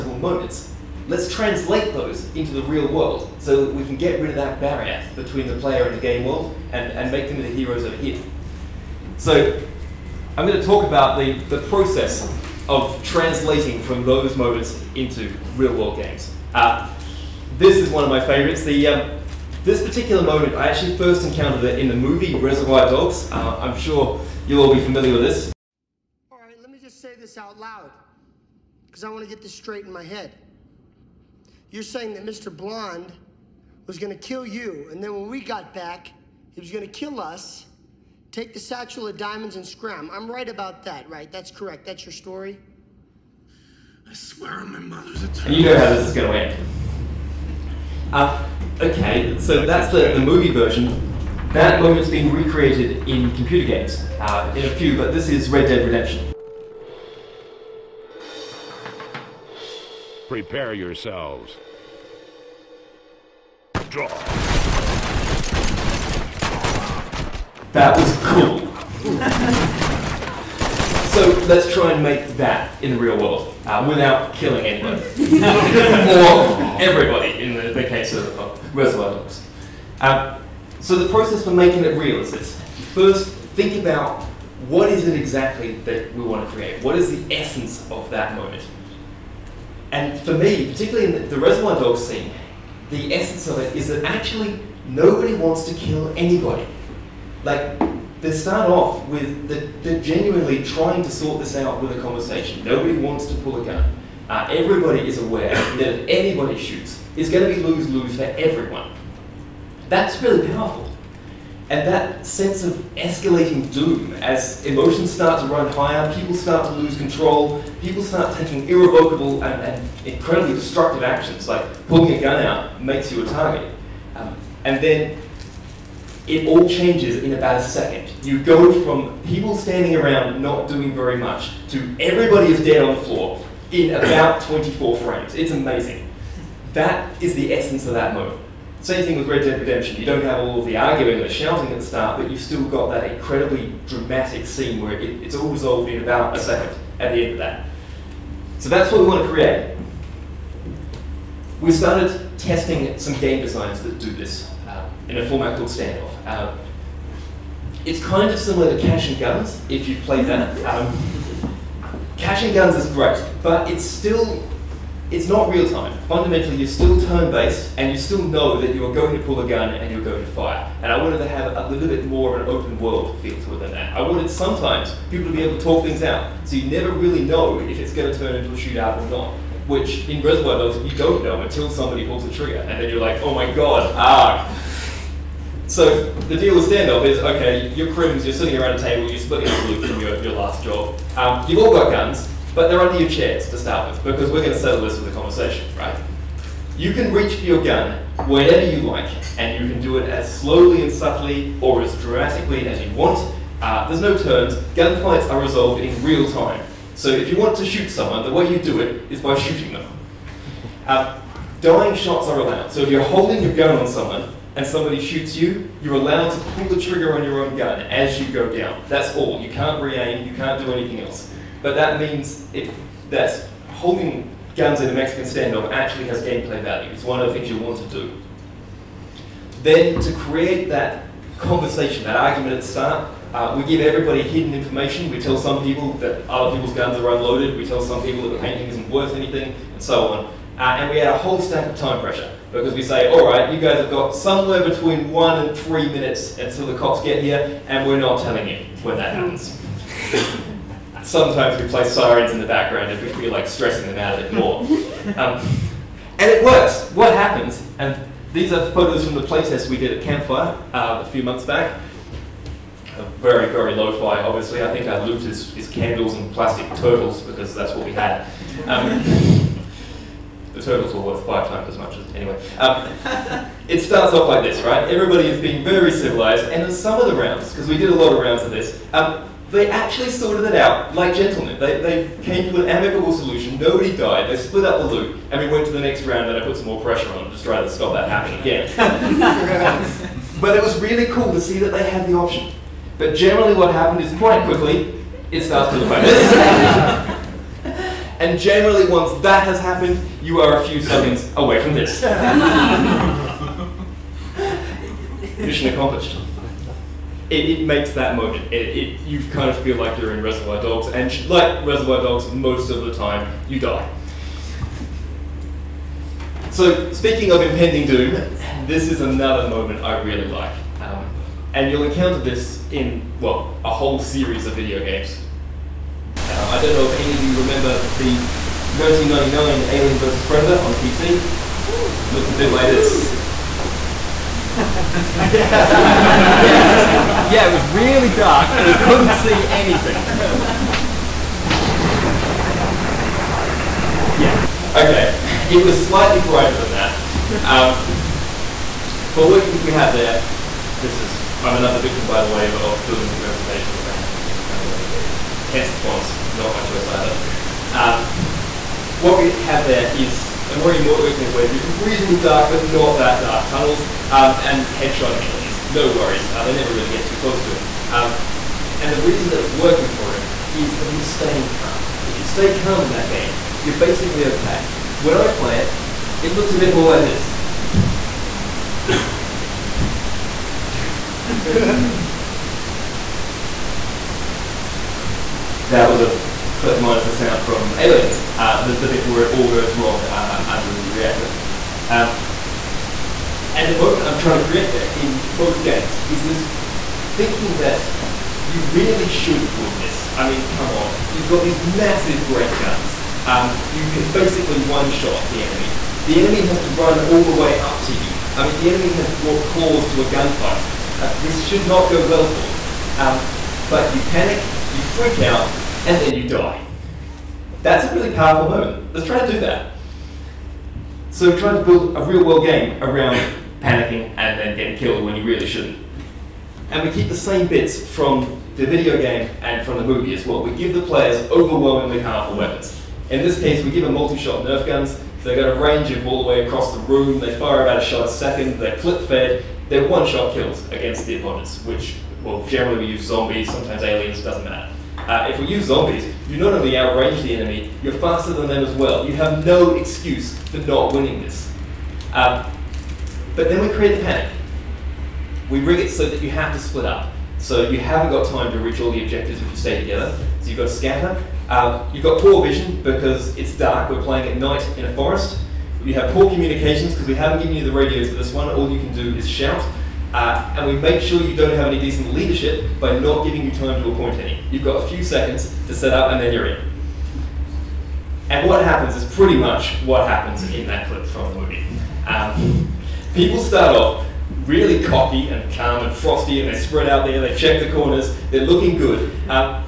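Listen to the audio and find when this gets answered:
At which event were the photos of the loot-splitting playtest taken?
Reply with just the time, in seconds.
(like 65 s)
260 s.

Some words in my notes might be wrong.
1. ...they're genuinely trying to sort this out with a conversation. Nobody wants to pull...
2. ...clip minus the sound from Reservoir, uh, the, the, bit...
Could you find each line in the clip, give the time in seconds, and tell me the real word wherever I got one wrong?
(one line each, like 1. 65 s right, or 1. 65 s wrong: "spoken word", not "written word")
1. 99 s right
2. 386 s wrong: "Aliens", not "Reservoir".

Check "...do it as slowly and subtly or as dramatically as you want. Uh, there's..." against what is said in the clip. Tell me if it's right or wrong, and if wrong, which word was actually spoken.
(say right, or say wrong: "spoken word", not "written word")
right.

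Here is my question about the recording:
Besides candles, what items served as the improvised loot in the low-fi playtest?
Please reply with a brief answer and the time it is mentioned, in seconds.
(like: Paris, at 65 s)
plastic turtles, at 266 s.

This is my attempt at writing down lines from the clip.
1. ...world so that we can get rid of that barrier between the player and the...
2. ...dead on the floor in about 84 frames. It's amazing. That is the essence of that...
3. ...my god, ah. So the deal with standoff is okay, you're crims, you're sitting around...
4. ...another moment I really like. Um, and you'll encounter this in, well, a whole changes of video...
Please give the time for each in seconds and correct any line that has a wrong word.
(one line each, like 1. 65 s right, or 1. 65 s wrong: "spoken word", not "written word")
1. 2 s right
2. 132 s wrong: "24", not "84"
3. 183 s right
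4. 319 s wrong: "series", not "changes".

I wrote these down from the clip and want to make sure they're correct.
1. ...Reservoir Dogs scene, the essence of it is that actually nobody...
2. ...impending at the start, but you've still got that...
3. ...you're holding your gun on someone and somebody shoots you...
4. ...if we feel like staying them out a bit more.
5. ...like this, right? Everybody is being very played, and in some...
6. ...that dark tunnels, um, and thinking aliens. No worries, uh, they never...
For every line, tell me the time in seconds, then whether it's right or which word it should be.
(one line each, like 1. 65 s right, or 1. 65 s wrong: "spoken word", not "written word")
1. 91 s right
2. 141 s wrong: "shouting", not "impending"
3. 212 s right
4. 252 s wrong: "stressing", not "staying"
5. 274 s wrong: "civilized", not "played"
6. 362 s wrong: "headshotting", not "thinking".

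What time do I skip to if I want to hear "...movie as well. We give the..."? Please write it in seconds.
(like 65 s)
429 s.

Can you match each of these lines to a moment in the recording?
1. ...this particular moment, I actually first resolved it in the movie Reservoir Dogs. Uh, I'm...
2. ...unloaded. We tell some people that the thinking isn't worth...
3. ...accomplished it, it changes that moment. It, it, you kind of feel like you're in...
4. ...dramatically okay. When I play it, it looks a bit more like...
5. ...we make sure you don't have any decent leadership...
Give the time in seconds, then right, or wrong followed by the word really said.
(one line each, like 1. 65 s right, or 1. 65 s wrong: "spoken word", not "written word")
1. 19 s wrong: "encountered", not "resolved"
2. 237 s wrong: "painting", not "thinking"
3. 305 s wrong: "makes", not "changes"
4. 373 s wrong: "basically", not "dramatically"
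5. 470 s right.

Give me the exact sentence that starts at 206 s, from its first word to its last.
So if you want to shoot someone, the way you do it is by shooting them.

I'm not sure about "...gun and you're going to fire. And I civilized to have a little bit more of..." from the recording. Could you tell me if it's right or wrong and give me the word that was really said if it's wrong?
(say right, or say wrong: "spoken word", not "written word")
wrong: "wanted", not "civilized".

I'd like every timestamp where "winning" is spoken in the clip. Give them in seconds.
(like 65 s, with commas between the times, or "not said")
450 s.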